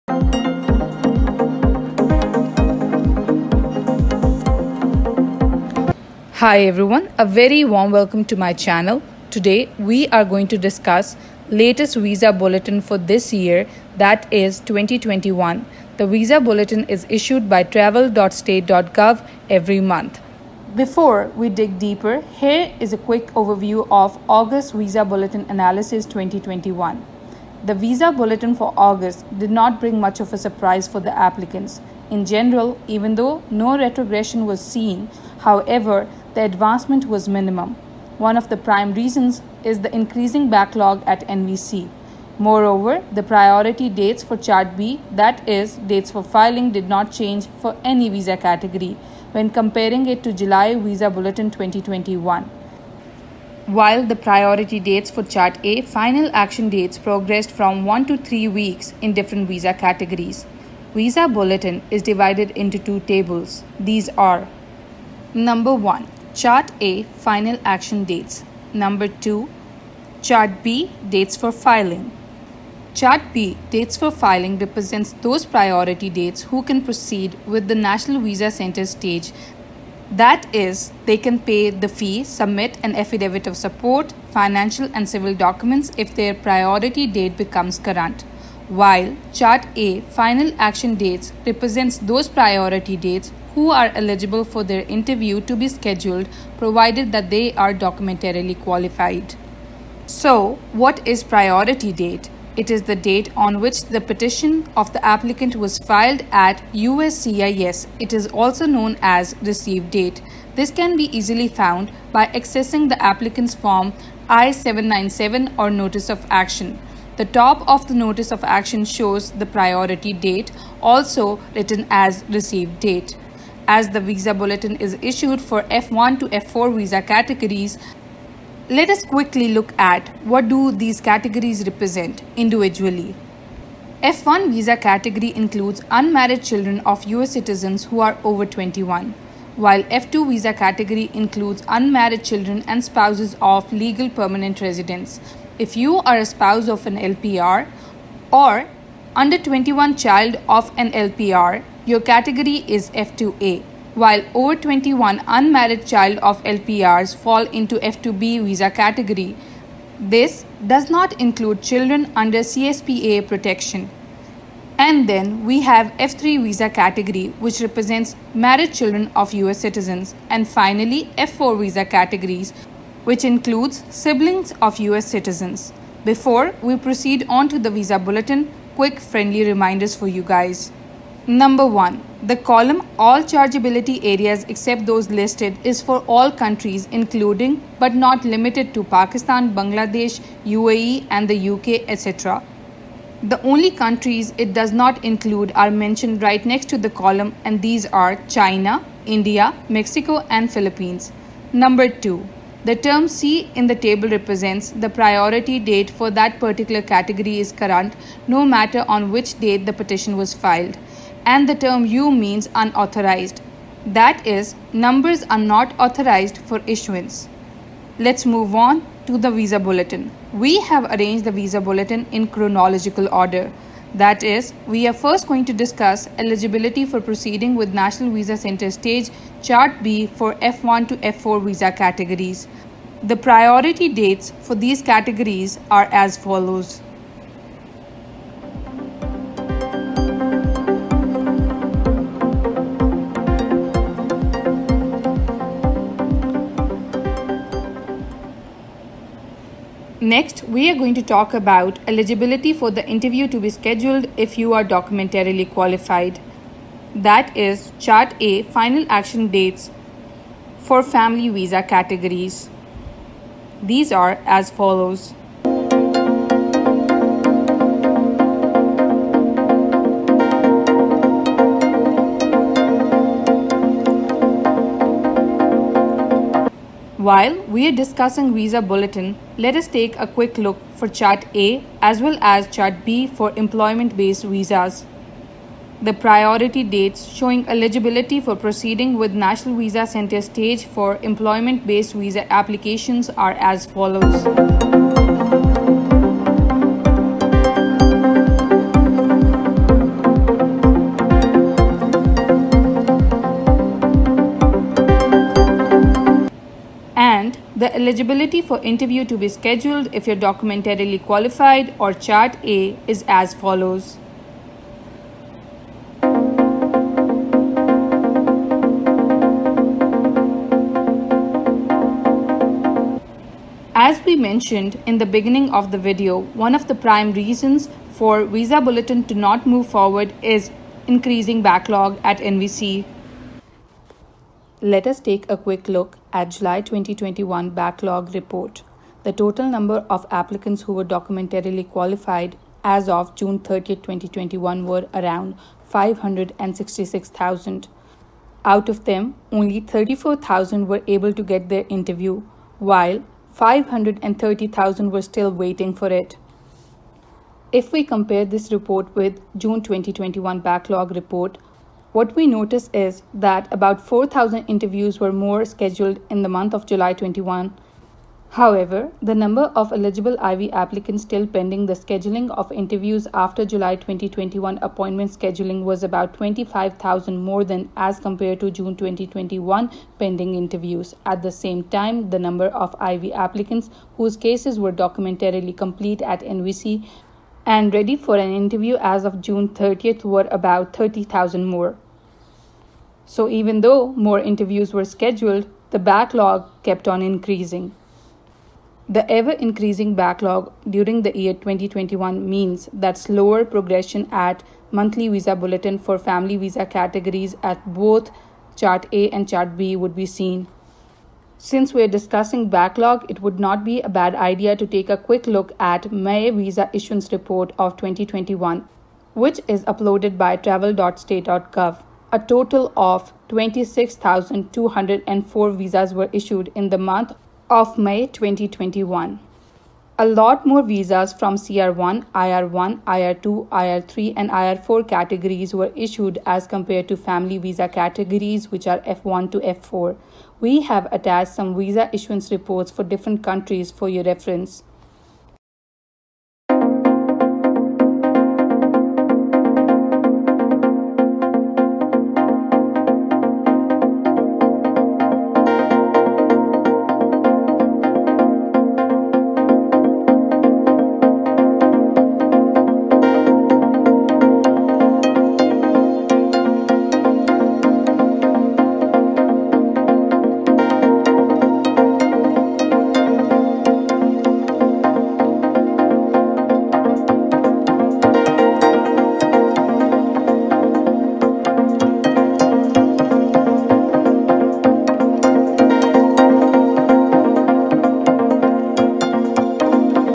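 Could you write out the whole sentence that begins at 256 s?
That is Chart A final action dates for family visa categories.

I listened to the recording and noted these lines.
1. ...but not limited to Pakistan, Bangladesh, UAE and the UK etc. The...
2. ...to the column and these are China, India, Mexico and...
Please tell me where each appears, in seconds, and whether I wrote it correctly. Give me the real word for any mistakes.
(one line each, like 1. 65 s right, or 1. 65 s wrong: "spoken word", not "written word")
1. 187 s right
2. 196 s right.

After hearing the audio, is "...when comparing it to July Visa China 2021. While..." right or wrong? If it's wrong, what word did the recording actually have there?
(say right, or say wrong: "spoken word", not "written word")
wrong: "Bulletin", not "China".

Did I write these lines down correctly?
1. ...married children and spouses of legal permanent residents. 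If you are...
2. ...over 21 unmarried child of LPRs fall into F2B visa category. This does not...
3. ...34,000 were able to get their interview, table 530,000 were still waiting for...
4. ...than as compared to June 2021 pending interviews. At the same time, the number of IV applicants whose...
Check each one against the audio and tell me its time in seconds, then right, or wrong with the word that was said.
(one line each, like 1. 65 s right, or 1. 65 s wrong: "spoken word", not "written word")
1. 141 s wrong: "unmarried", not "married"
2. 154 s right
3. 349 s wrong: "while", not "table"
4. 377 s right.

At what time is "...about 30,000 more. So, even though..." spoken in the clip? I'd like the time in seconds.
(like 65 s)
390 s.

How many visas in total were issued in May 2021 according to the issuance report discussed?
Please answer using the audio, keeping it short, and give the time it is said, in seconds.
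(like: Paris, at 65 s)
26,204, at 423 s.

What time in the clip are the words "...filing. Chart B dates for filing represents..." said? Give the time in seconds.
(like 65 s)
71 s.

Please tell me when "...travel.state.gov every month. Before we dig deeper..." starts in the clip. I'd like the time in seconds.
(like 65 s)
17 s.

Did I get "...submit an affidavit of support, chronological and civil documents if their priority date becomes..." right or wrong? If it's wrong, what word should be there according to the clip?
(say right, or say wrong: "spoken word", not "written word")
wrong: "financial", not "chronological".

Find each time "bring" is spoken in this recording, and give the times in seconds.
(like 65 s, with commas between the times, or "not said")
29 s.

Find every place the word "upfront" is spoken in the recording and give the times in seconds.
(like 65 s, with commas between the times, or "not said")
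not said.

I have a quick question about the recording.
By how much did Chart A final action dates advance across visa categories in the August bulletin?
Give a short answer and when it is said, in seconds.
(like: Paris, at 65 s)
1 to 3 weeks, at 57 s.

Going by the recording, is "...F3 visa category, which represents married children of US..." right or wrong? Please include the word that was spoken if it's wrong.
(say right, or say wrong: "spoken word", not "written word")
right.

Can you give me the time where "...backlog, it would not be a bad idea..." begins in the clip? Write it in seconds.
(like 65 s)
412 s.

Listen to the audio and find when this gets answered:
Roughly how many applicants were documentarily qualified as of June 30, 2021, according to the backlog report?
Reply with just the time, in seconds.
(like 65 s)
345 s.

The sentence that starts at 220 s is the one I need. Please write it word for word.
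We have arranged the visa bulletin in chronological order.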